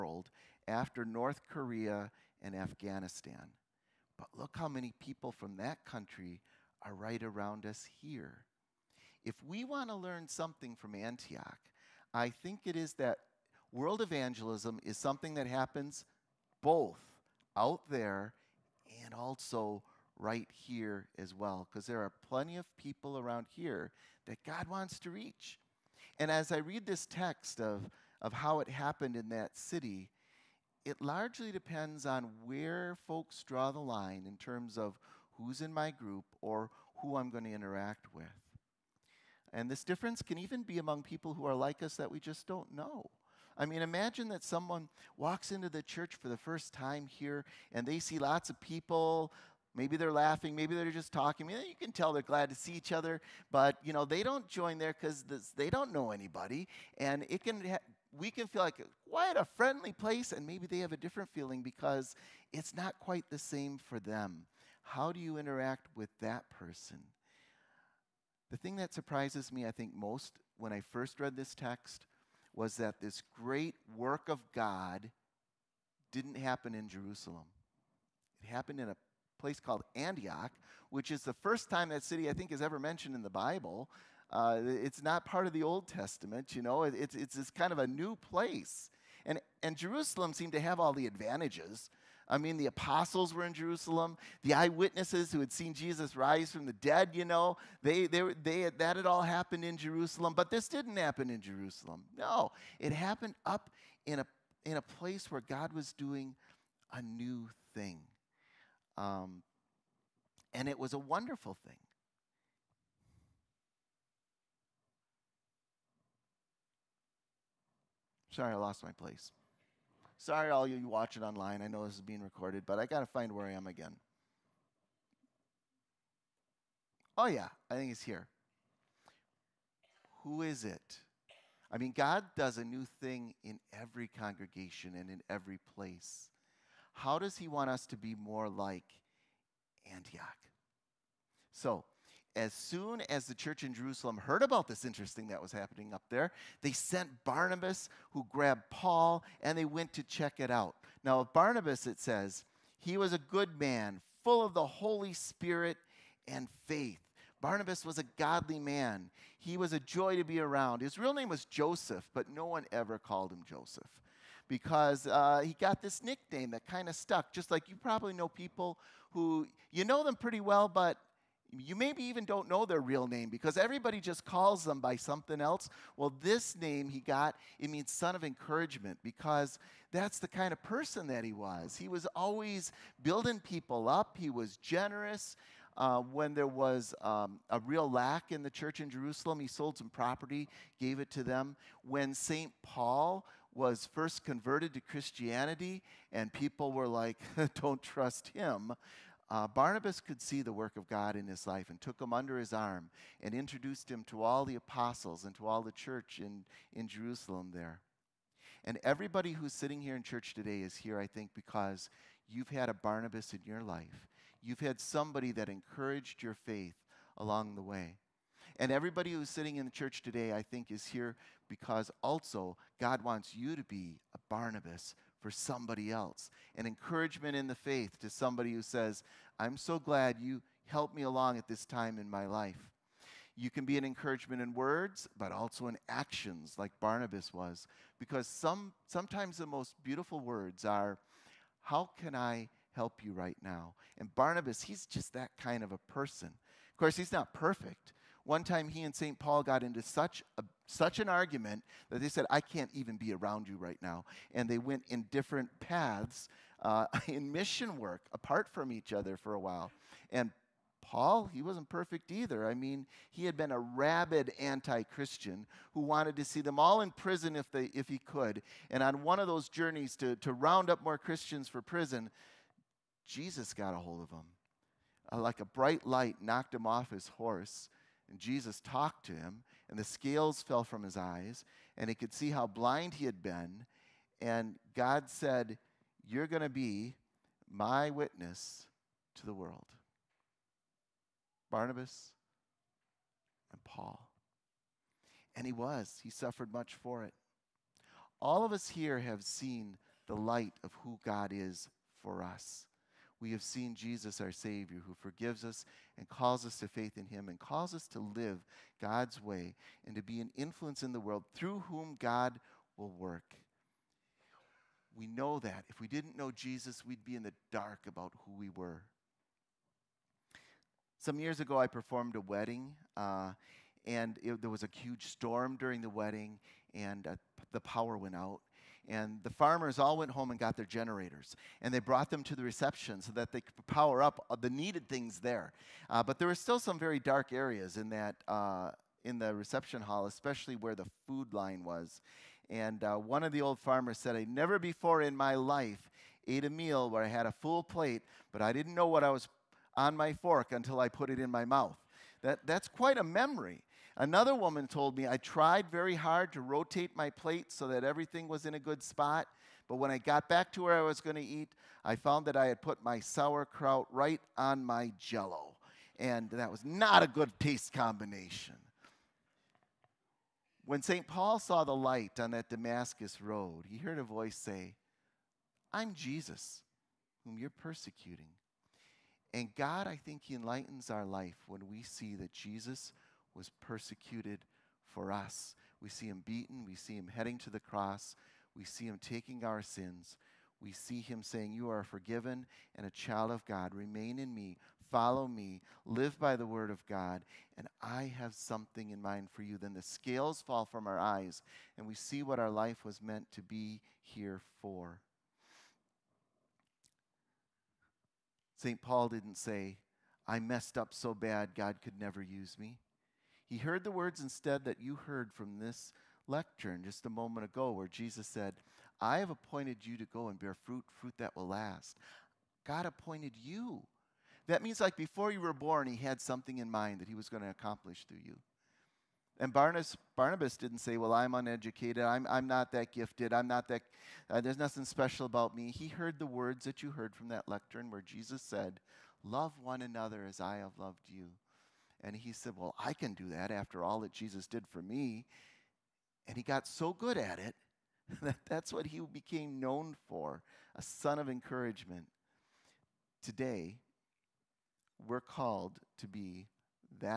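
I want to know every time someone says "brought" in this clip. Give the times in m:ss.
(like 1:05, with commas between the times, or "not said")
5:31.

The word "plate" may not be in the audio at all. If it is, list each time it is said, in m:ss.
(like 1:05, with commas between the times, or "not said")
5:47, 5:57.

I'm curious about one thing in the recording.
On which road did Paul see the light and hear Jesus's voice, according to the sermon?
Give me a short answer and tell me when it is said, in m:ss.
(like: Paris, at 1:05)
Damascus road, at 6:12.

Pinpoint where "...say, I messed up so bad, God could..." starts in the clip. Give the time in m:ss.
6:49.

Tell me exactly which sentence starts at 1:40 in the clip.
But this didn't happen in Jerusalem.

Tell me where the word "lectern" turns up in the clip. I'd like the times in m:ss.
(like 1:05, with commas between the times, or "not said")
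6:56, 7:17.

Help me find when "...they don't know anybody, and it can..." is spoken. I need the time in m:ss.
0:55.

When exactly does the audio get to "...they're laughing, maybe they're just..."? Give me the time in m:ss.
0:49.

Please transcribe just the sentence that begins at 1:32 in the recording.
I mean, the apostles were in Jerusalem.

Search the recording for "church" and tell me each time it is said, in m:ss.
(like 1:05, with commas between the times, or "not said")
0:45, 2:23, 3:08, 3:25, 3:30, 3:39.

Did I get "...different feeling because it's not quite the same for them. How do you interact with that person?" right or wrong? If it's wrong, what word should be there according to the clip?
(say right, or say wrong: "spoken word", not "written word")
right.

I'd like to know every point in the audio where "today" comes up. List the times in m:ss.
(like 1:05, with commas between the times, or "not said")
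3:30, 3:40, 7:33.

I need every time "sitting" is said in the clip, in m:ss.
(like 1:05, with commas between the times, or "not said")
3:29, 3:39.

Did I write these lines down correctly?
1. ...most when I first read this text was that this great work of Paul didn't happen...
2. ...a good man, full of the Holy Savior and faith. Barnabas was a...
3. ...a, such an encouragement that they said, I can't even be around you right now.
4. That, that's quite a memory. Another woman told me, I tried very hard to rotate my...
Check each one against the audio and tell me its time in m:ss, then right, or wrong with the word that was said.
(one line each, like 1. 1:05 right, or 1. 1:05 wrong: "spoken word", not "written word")
1. 1:09 wrong: "God", not "Paul"
2. 2:33 wrong: "Spirit", not "Savior"
3. 4:10 wrong: "argument", not "encouragement"
4. 5:52 right.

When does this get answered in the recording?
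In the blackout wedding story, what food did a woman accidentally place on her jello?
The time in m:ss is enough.
6:03.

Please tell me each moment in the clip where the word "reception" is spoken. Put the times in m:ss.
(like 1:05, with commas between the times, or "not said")
5:32, 5:39.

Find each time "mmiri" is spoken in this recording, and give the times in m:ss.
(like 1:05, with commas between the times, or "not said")
not said.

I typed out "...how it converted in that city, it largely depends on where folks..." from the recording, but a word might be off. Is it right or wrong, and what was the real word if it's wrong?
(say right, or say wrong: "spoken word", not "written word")
wrong: "happened", not "converted".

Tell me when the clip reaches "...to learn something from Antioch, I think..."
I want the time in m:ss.
0:09.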